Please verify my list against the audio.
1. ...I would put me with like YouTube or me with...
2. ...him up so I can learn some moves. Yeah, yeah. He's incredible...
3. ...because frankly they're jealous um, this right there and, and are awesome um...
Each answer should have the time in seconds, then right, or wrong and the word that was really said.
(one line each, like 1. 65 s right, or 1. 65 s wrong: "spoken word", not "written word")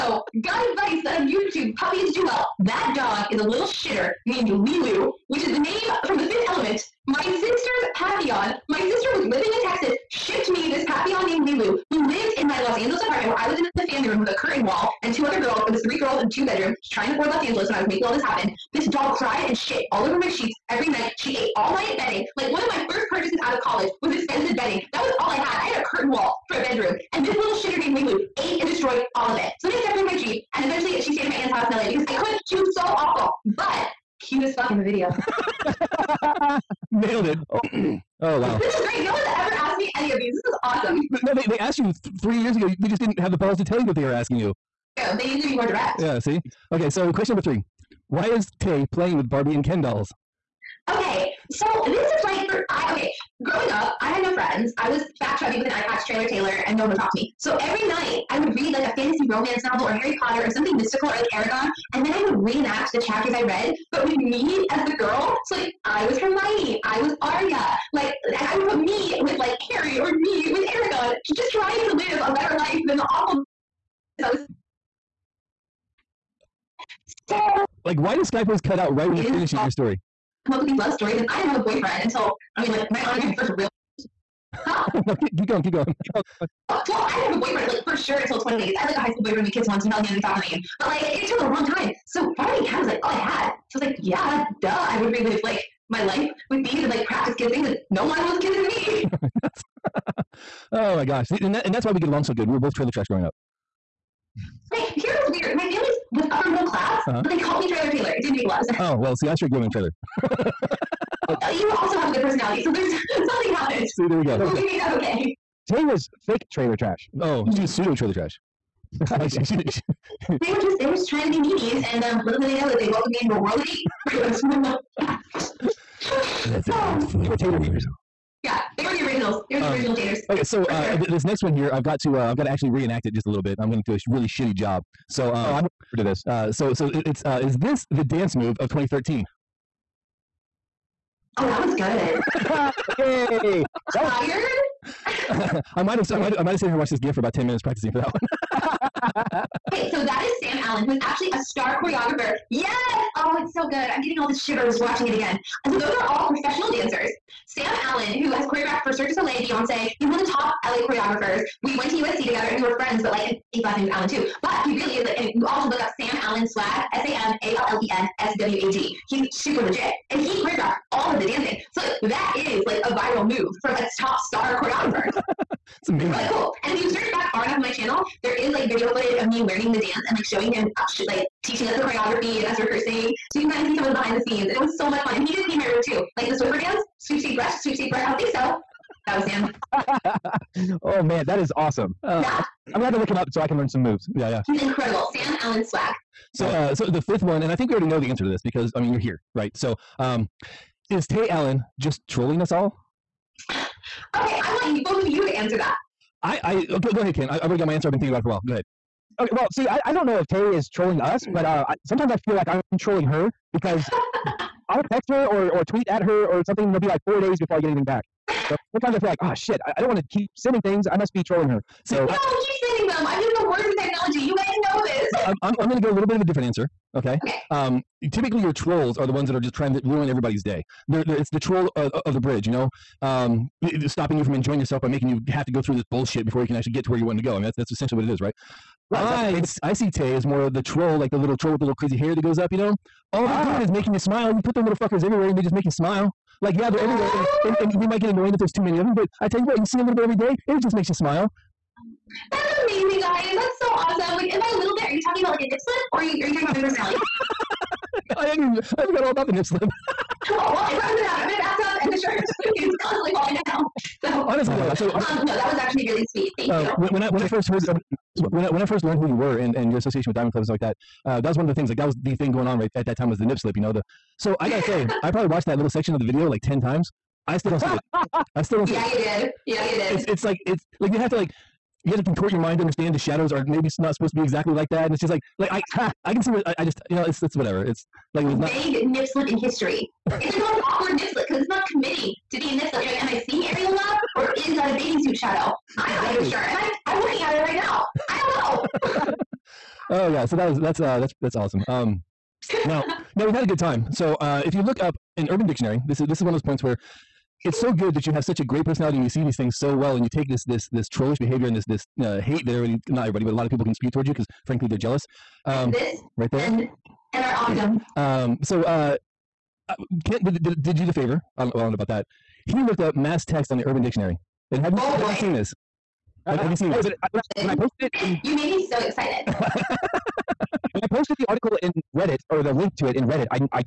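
1. 68 s wrong: "Harry", not "YouTube"
2. 193 s right
3. 314 s right.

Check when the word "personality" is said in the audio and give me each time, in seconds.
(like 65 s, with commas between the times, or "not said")
112 s, 256 s, 308 s.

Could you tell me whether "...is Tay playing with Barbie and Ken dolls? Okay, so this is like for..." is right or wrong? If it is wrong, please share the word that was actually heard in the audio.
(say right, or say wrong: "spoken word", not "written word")
right.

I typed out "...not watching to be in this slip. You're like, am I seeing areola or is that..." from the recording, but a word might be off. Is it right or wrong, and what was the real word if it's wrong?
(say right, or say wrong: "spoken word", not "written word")
wrong: "committing", not "watching".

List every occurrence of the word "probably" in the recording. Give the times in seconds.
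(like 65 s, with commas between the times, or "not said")
260 s, 275 s.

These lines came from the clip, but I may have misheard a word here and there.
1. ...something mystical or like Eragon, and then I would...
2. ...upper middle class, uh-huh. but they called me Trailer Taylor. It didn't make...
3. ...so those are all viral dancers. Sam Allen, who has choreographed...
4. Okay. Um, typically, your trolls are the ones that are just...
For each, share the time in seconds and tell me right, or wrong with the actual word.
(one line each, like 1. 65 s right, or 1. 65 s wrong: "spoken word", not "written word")
1. 60 s right
2. 106 s right
3. 155 s wrong: "professional", not "viral"
4. 227 s right.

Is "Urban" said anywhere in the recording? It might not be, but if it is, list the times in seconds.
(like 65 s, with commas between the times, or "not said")
305 s, 323 s.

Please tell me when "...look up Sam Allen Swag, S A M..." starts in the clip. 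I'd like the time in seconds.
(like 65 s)
165 s.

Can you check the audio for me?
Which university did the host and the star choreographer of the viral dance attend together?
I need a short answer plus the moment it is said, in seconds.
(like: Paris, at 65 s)
USC, at 161 s.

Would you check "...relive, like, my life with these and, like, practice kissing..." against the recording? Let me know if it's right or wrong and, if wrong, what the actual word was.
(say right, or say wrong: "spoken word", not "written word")
right.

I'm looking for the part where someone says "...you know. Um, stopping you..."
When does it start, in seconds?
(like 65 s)
232 s.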